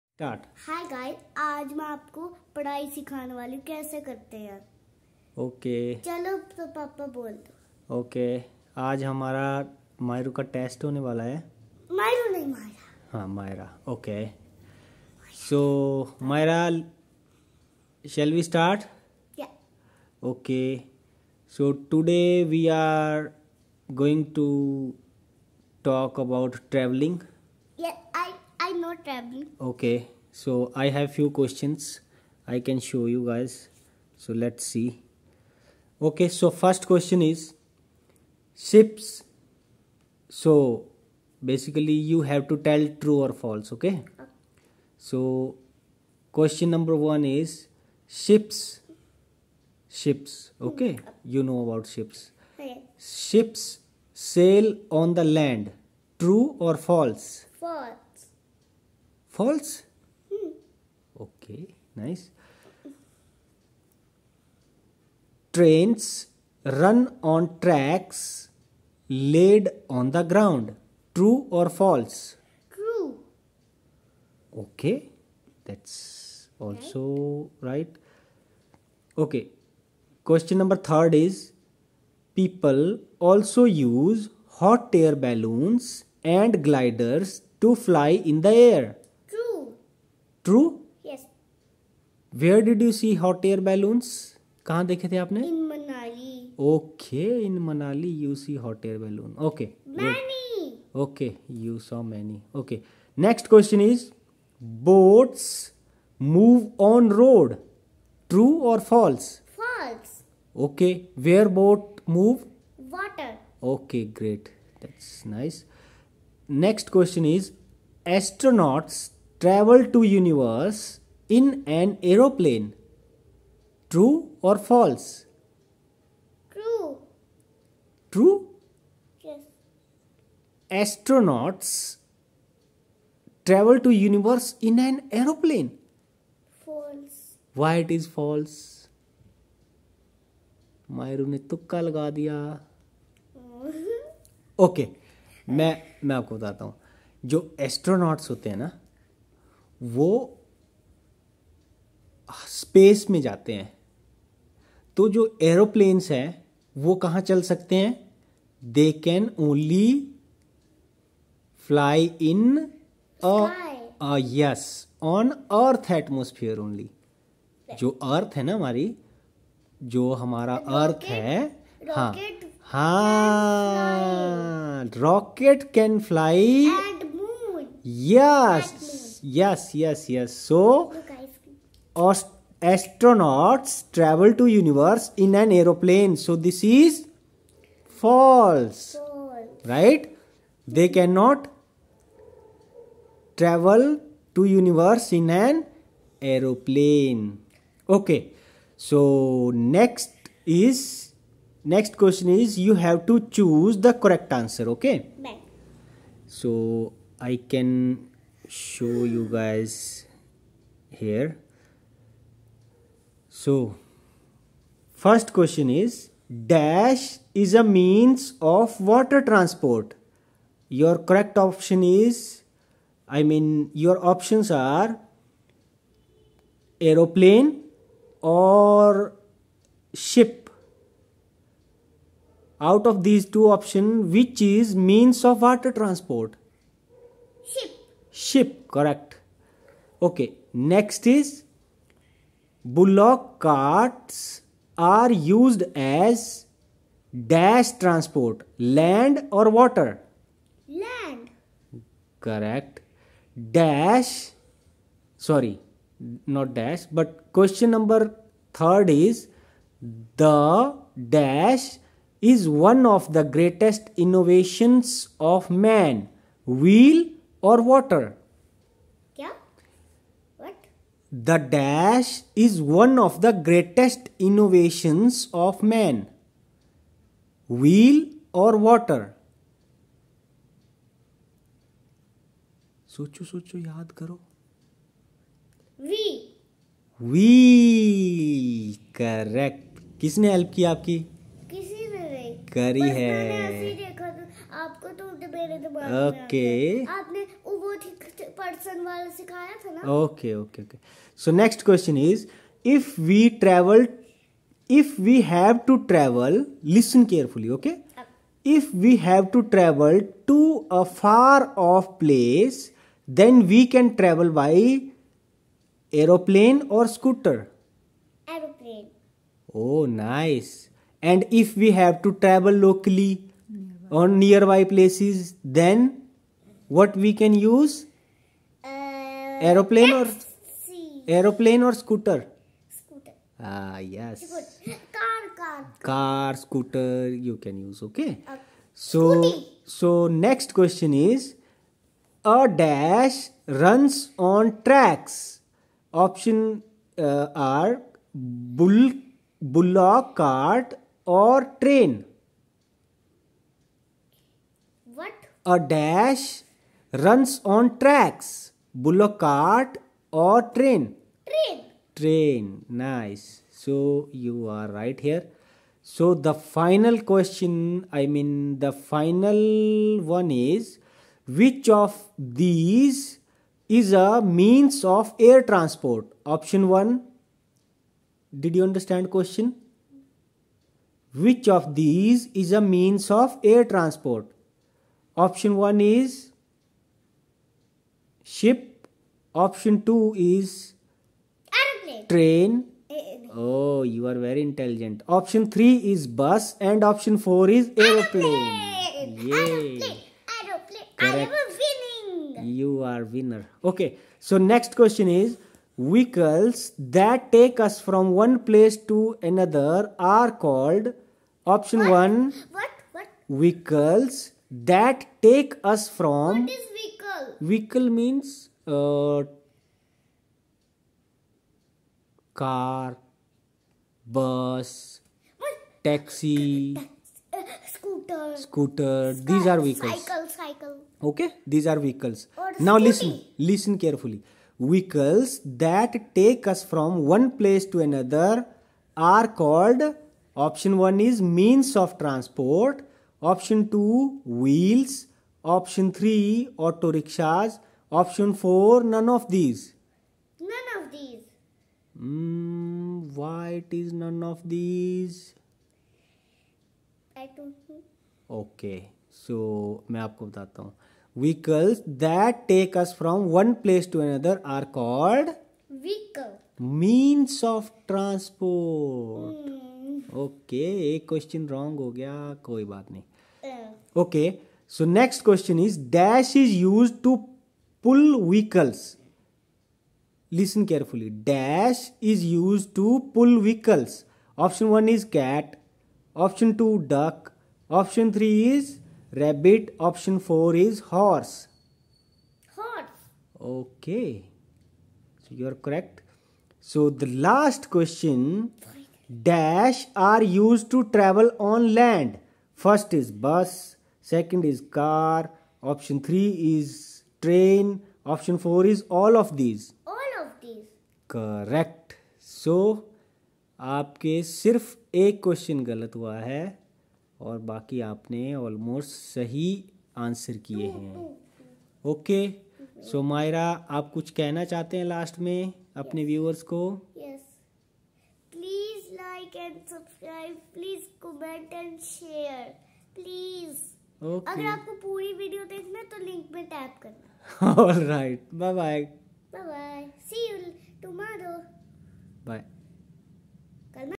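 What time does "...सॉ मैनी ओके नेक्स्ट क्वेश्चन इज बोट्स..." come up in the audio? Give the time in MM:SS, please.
01:41.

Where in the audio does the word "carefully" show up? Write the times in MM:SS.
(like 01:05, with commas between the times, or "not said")
07:13, 08:00.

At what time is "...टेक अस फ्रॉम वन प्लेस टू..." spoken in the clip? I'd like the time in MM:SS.
07:42.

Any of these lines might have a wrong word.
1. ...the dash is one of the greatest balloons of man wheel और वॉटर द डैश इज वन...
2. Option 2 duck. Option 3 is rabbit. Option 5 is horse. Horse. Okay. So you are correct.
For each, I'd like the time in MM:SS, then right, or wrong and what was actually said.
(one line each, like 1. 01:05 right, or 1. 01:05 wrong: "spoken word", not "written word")
1. 04:20 wrong: "innovations", not "balloons"
2. 08:06 wrong: "4", not "5".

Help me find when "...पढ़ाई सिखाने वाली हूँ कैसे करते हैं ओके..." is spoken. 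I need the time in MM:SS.
00:02.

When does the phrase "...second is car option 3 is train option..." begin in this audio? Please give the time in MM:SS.
08:24.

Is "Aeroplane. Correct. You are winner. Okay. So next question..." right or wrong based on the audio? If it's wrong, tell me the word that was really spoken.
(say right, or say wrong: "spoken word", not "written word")
right.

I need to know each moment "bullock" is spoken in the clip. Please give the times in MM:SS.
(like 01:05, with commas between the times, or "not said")
04:02, 05:49, 05:58.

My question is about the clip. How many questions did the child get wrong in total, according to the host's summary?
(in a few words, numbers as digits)
1.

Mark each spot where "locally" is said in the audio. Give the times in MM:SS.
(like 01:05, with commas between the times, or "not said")
05:22.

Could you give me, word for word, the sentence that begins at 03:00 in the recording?
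So, astronauts travel to universe in an aeroplane.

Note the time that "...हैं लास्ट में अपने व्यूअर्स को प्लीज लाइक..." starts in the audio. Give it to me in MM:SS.
08:44.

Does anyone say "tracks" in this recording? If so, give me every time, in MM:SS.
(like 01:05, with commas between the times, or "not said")
01:07, 05:44, 05:57.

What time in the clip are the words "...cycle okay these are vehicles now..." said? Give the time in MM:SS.
07:10.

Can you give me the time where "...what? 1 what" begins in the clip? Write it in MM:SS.
06:51.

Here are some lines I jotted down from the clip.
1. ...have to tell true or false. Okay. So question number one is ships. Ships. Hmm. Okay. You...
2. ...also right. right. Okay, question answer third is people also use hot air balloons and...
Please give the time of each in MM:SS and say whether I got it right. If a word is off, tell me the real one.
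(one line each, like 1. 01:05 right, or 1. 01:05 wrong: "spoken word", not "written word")
1. 00:42 right
2. 01:16 wrong: "number", not "answer".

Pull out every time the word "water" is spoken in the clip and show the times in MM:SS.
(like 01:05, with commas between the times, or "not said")
03:38, 03:55, 04:09.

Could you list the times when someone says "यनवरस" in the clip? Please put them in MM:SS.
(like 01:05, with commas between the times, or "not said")
02:00, 02:13.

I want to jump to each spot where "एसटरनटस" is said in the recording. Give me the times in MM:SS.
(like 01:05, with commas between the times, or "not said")
01:58, 02:10, 02:27.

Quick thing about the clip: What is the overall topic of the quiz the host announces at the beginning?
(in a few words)
Traveling.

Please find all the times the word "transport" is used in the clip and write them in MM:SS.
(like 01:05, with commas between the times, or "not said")
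03:39, 03:55, 04:07, 06:15, 06:23, 07:22.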